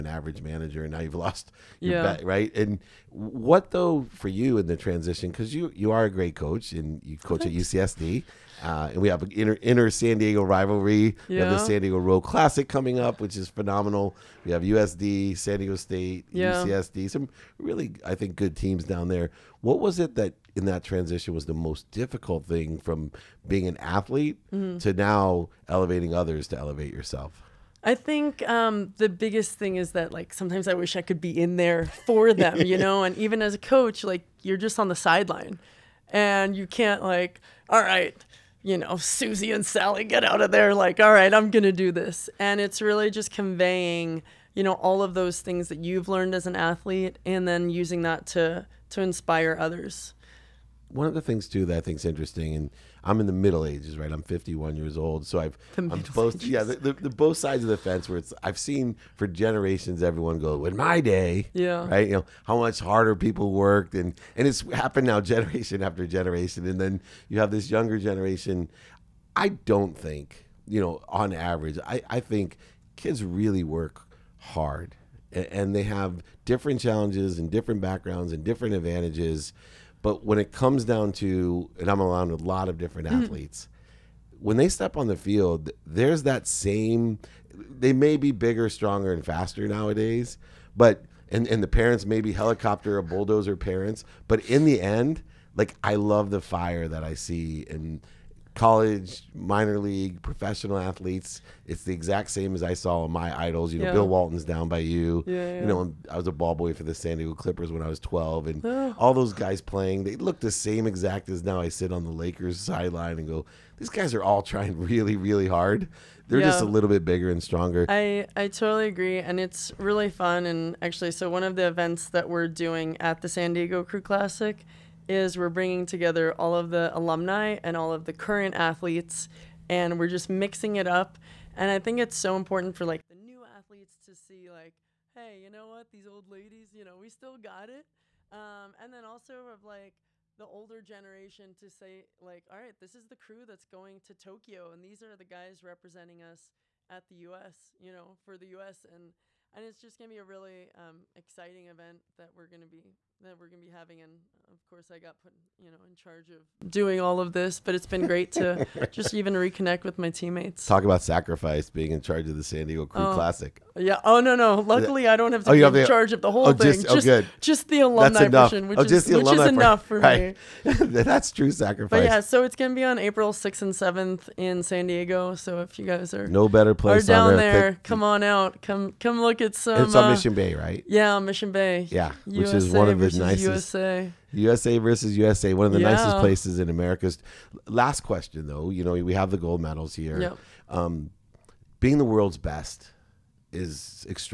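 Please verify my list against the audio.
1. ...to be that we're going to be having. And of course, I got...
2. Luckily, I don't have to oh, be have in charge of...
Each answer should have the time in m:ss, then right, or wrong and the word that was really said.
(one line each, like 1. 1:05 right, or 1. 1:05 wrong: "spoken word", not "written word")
1. 2:32 right
2. 2:44 right.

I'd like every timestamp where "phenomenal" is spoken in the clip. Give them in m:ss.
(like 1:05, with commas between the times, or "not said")
0:13.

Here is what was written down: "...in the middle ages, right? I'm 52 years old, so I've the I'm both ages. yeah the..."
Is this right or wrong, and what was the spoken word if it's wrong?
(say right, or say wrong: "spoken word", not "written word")
wrong: "51", not "52".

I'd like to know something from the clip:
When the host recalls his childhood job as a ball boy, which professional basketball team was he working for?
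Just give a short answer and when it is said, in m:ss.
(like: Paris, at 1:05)
San Diego Clippers, at 1:46.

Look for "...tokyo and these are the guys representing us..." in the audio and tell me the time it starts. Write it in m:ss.
2:24.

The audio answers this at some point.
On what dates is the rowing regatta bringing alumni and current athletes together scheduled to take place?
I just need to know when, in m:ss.
2:52.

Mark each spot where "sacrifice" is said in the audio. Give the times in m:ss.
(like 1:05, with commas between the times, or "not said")
2:41, 2:51.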